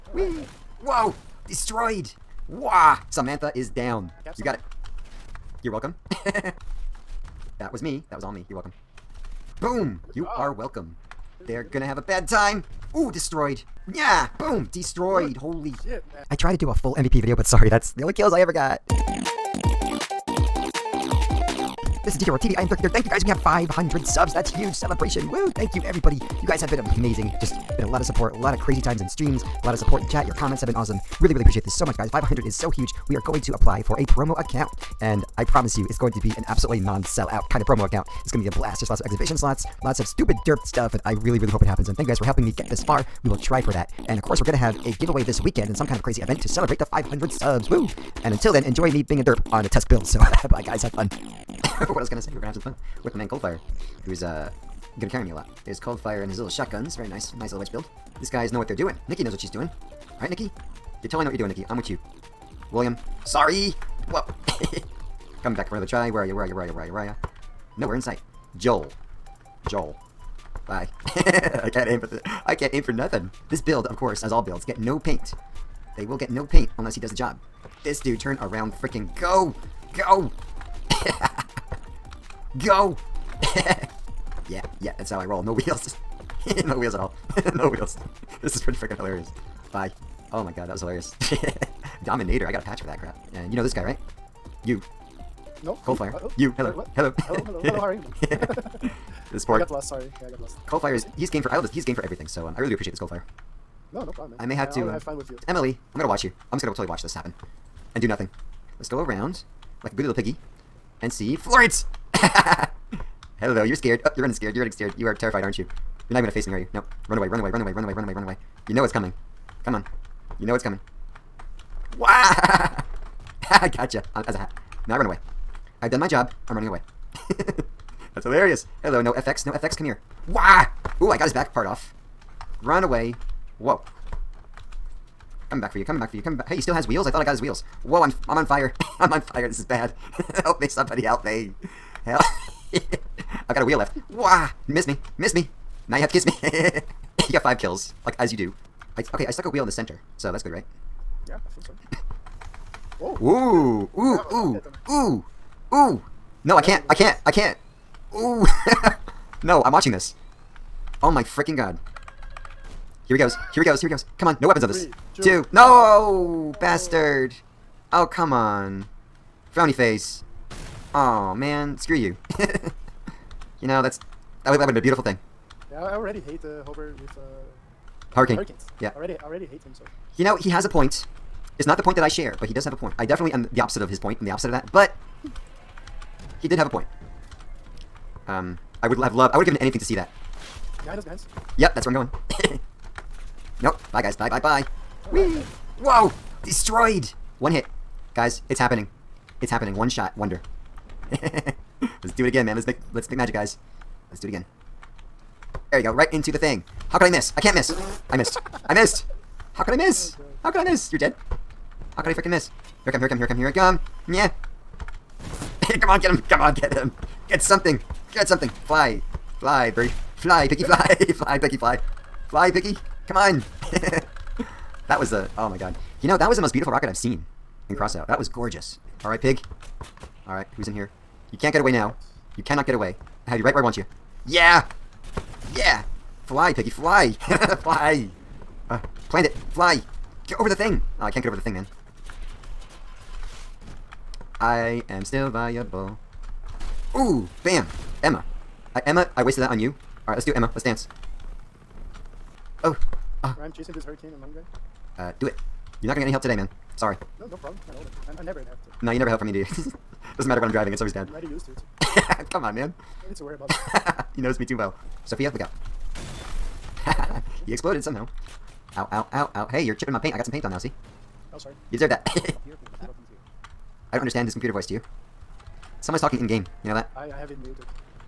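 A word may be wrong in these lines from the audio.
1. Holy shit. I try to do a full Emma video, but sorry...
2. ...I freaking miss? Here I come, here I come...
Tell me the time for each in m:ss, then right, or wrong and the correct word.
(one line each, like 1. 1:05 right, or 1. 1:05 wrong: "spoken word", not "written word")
1. 0:15 wrong: "MVP", not "Emma"
2. 3:32 right.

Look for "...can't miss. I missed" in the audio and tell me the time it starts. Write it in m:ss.
3:27.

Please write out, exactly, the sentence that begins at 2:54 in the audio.
That would, that would have been a beautiful thing.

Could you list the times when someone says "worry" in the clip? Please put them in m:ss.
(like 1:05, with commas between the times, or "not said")
4:23.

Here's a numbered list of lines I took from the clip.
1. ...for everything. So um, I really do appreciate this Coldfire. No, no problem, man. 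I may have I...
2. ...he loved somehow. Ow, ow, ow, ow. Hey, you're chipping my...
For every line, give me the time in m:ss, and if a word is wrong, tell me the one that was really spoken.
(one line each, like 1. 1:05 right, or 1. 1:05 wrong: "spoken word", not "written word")
1. 1:41 right
2. 4:27 wrong: "exploded", not "loved".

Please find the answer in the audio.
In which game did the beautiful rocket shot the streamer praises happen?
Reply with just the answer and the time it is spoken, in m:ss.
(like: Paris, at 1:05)
Crossout, at 3:47.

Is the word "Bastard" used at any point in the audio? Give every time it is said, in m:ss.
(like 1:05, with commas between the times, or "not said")
2:46.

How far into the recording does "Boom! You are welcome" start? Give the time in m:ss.
0:09.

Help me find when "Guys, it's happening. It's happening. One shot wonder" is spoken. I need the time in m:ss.
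3:18.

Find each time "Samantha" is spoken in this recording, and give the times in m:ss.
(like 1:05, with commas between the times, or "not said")
0:03.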